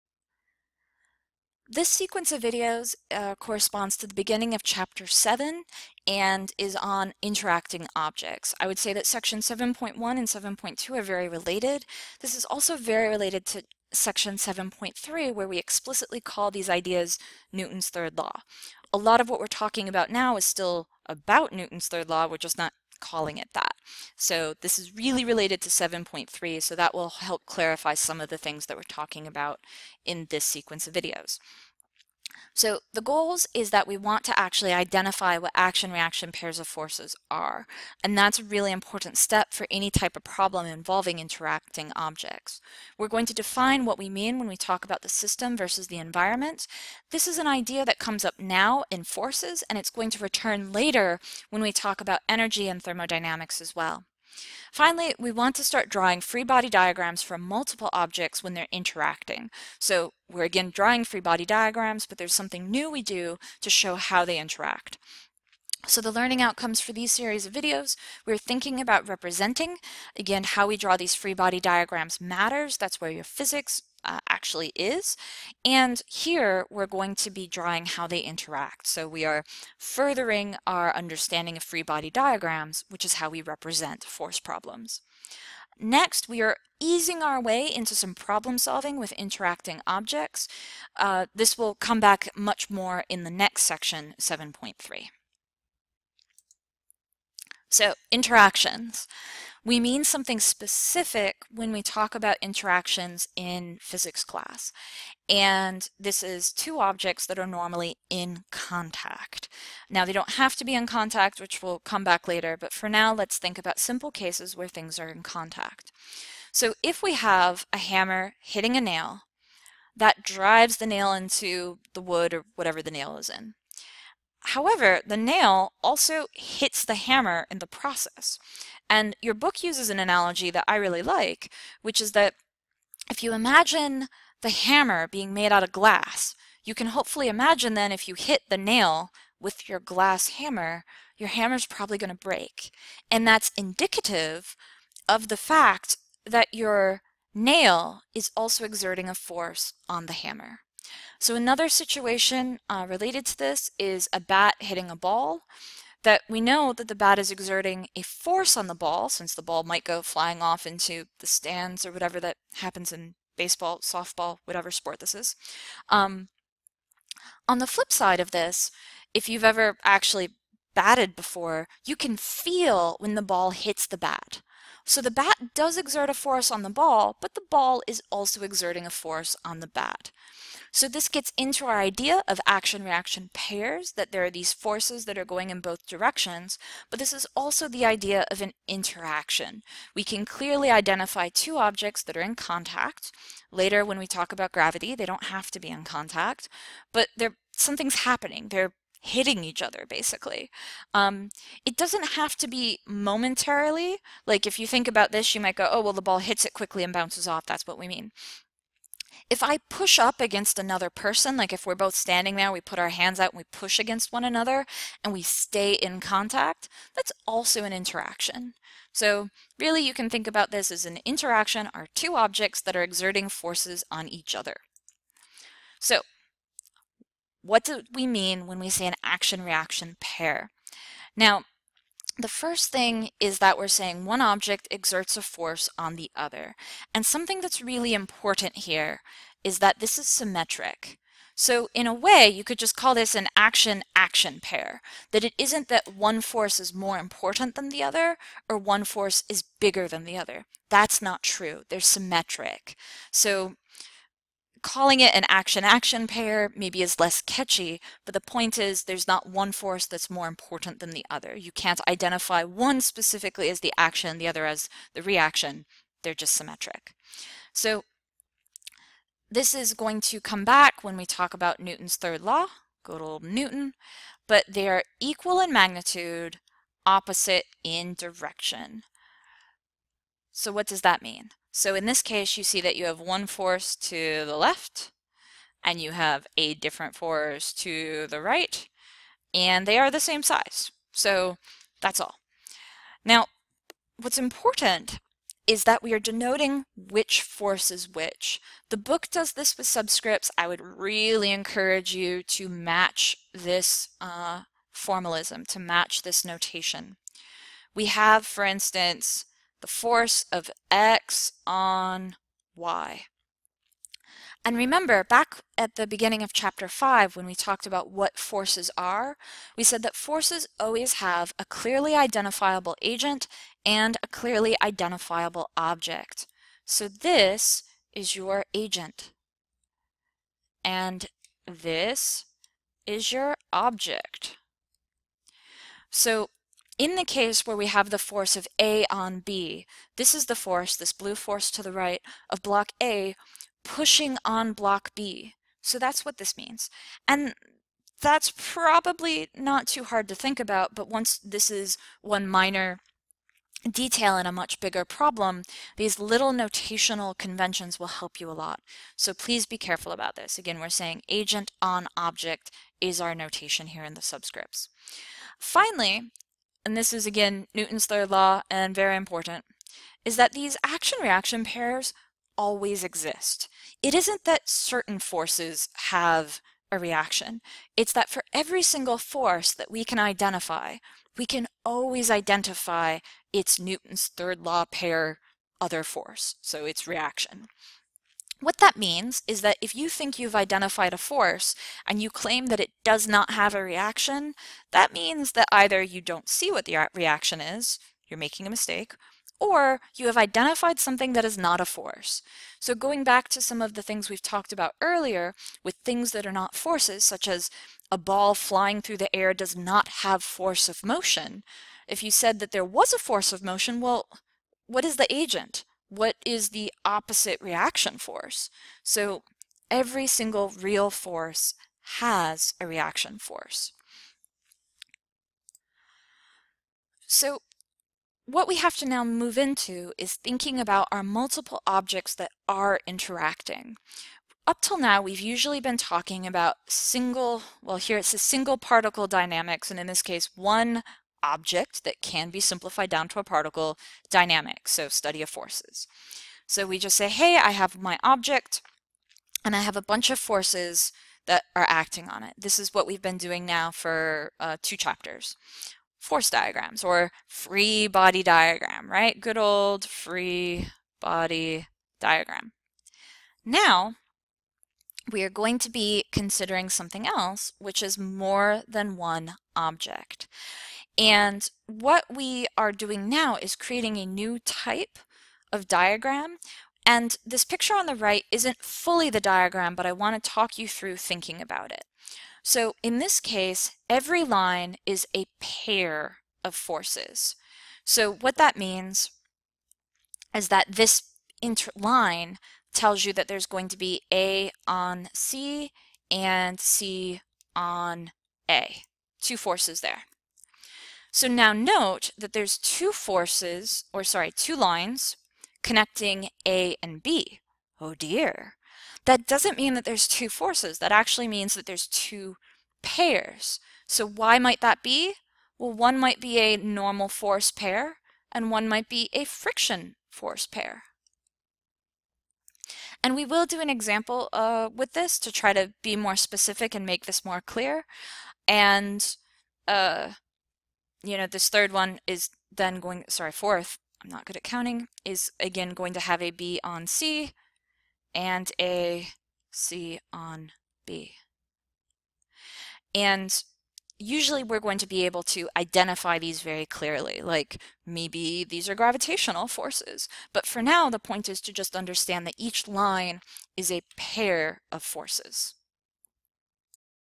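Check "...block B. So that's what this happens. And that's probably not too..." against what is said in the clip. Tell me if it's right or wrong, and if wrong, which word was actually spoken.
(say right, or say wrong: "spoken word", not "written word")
wrong: "means", not "happens".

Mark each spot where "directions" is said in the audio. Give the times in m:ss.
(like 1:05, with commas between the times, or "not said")
3:05, 4:37.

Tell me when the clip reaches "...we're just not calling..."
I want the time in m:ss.
0:22.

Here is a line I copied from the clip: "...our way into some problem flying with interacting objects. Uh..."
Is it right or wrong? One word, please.
wrong.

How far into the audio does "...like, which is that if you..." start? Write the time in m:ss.
2:11.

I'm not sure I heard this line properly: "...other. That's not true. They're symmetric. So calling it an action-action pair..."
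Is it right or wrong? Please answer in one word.
right.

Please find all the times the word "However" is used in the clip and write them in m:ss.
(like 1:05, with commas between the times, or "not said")
2:04.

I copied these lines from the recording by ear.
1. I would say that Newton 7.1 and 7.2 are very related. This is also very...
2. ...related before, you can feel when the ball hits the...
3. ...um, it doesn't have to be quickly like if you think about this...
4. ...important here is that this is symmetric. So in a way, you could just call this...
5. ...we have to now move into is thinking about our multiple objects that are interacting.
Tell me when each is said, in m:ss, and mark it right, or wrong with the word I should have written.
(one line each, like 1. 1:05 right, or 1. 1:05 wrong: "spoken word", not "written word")
1. 0:08 wrong: "Section", not "Newton"
2. 2:50 wrong: "batted", not "related"
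3. 3:20 wrong: "momentarily", not "quickly"
4. 3:57 right
5. 7:08 right.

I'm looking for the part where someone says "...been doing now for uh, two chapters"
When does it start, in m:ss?
7:33.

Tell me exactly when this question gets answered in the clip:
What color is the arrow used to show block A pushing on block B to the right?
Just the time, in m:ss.
5:40.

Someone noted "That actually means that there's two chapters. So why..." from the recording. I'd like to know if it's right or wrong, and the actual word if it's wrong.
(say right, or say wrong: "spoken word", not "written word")
wrong: "pairs", not "chapters".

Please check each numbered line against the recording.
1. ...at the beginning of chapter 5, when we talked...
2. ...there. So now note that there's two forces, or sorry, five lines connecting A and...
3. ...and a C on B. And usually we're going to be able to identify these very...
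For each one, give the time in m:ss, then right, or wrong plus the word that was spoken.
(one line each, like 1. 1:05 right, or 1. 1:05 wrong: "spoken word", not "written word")
1. 5:15 right
2. 8:19 wrong: "two", not "five"
3. 8:58 right.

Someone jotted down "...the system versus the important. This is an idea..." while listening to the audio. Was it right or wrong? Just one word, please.
wrong.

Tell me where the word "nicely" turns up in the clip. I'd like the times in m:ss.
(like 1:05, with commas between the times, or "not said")
not said.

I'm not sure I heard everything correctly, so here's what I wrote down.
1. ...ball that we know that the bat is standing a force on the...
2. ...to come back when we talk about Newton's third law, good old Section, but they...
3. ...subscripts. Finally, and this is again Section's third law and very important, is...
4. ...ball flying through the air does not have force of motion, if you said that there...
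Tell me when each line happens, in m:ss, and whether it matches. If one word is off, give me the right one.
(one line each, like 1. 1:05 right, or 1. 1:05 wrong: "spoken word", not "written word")
1. 2:34 wrong: "exerting", not "standing"
2. 4:30 wrong: "Newton", not "Section"
3. 6:04 wrong: "Newton", not "Section"
4. 6:47 right.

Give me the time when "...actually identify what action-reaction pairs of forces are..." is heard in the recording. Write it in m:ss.
0:34.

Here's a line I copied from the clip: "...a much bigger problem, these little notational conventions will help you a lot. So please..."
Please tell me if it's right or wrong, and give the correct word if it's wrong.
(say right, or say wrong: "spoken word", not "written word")
right.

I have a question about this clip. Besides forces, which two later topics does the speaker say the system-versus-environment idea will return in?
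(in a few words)
energy and thermodynamics.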